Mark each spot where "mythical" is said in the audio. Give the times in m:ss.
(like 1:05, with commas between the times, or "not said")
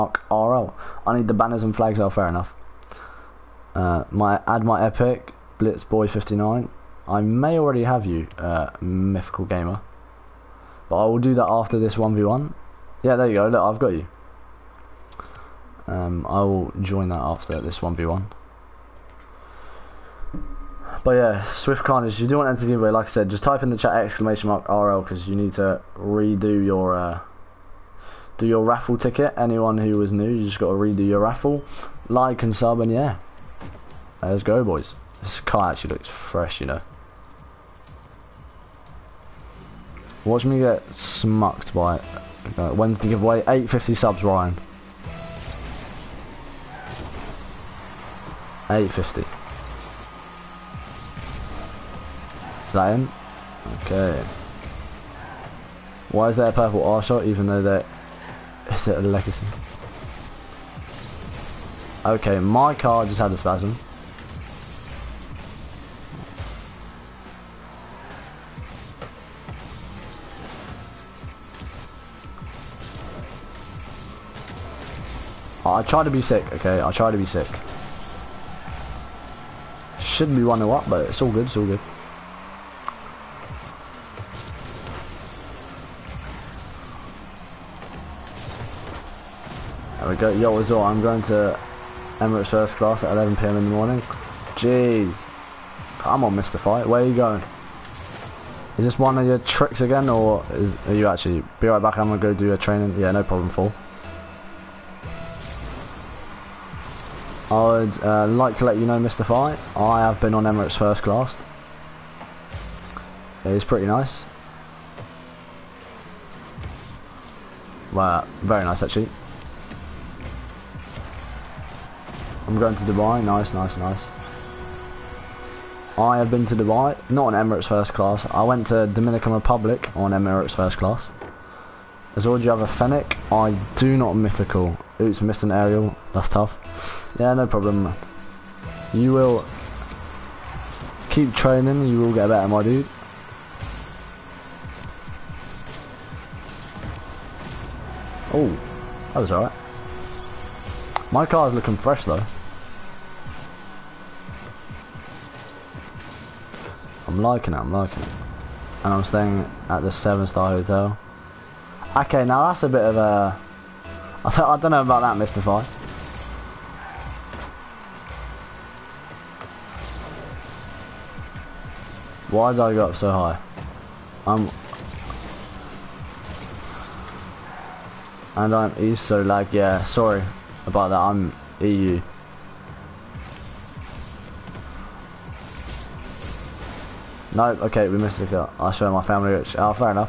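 0:08, 2:14.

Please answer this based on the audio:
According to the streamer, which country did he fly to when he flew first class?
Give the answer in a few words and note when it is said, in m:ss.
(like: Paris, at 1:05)
Dominican Republic, at 2:08.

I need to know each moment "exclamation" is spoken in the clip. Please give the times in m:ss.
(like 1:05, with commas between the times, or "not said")
0:23.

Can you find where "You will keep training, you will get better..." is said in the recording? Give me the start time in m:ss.
2:18.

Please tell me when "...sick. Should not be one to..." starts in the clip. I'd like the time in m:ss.
1:17.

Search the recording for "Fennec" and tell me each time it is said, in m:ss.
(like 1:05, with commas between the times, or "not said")
2:12.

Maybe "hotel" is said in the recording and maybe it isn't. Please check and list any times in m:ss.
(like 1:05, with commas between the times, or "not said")
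2:40.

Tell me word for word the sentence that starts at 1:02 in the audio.
Okay, my car just had a spasm.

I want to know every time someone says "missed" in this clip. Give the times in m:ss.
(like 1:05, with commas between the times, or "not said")
2:15, 3:07.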